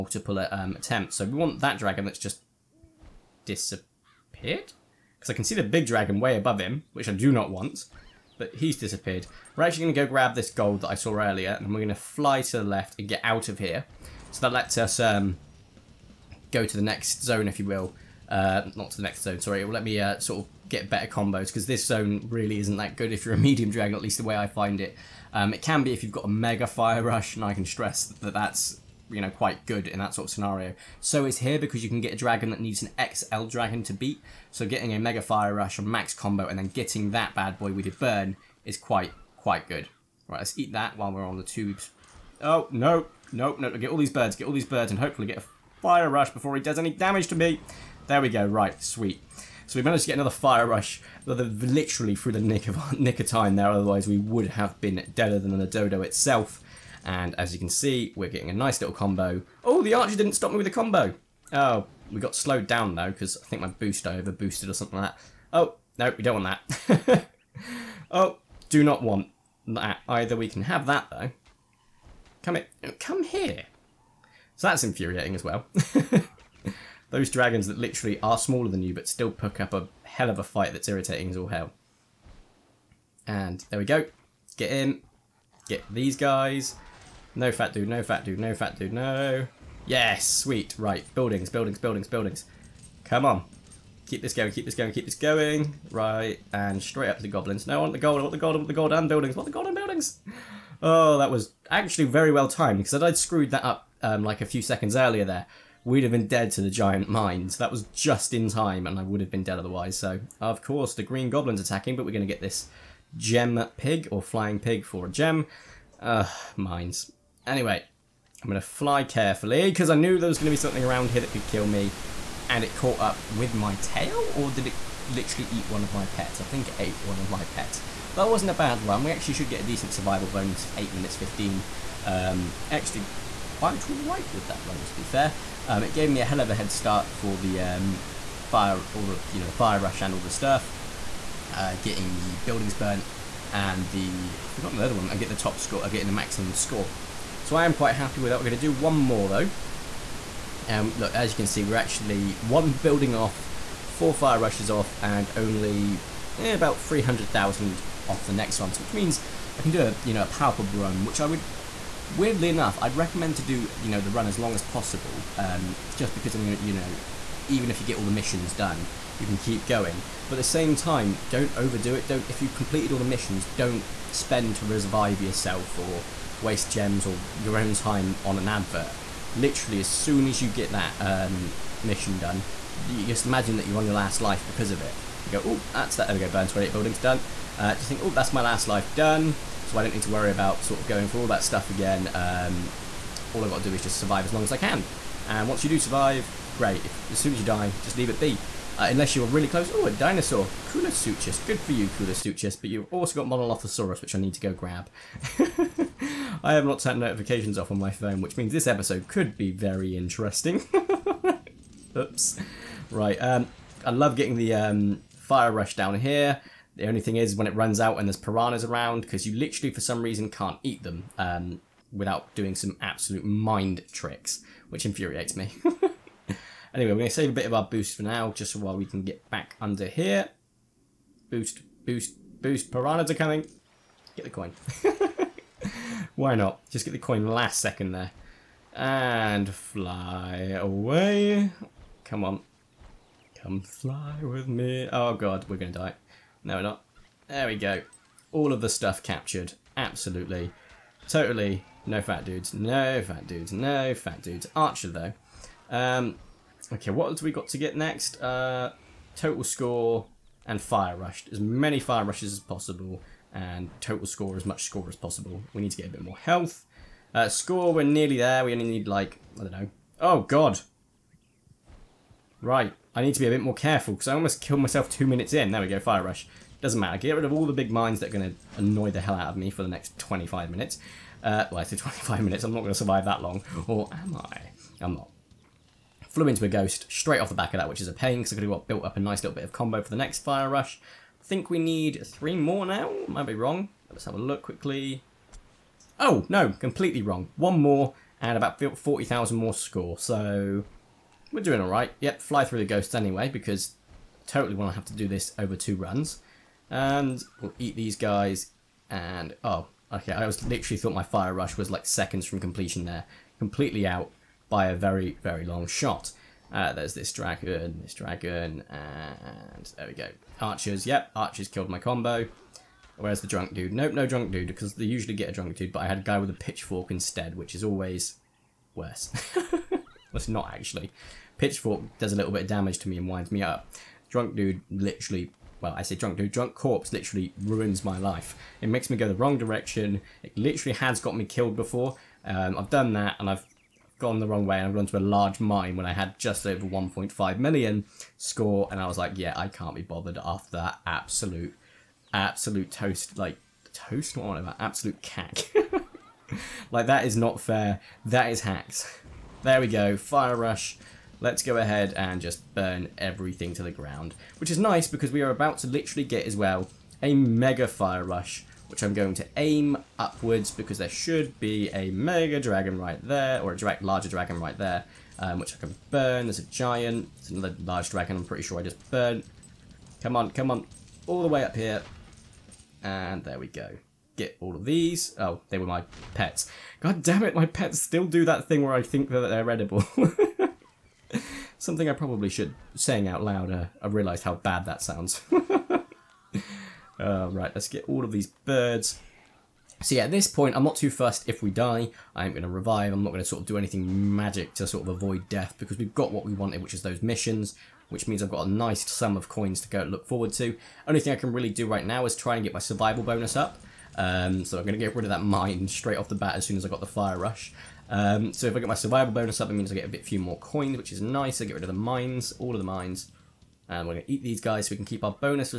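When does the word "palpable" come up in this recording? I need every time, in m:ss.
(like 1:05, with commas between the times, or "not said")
2:40.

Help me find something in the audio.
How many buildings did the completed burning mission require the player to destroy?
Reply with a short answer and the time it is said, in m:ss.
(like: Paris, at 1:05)
28, at 3:06.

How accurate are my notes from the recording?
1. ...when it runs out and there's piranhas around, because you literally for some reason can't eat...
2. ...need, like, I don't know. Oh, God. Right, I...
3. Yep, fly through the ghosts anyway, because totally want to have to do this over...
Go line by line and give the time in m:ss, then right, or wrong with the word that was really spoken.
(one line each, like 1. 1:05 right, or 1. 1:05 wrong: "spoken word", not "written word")
1. 3:37 right
2. 4:28 right
3. 5:01 right.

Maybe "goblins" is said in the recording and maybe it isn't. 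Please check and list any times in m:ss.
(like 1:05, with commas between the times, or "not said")
1:37, 1:51.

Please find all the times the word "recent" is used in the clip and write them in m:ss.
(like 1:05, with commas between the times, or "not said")
not said.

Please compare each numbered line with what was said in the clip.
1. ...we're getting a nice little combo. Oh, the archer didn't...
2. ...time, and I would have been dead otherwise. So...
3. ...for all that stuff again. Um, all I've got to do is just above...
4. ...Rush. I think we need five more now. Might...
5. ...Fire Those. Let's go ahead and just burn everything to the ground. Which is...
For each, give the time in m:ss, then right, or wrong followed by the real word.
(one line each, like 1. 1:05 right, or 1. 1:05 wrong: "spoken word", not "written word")
1. 0:58 right
2. 1:48 right
3. 3:11 wrong: "survive", not "above"
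4. 4:50 wrong: "three", not "five"
5. 5:59 wrong: "Rush", not "Those".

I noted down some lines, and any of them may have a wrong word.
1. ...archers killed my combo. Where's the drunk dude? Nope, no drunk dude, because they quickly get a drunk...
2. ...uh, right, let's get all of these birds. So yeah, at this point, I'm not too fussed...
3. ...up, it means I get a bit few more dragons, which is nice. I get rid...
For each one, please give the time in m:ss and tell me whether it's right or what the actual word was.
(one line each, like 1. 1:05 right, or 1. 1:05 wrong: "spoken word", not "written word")
1. 5:21 wrong: "usually", not "quickly"
2. 6:36 right
3. 6:59 wrong: "coins", not "dragons".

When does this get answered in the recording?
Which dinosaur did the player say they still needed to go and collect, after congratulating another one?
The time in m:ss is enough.
3:23.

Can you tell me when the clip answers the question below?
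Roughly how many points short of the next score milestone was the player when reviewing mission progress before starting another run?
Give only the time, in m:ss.
2:36.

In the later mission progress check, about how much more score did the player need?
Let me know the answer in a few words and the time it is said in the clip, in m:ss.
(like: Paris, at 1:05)
40,000, at 4:58.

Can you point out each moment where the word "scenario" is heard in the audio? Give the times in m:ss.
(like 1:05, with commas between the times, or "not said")
0:30.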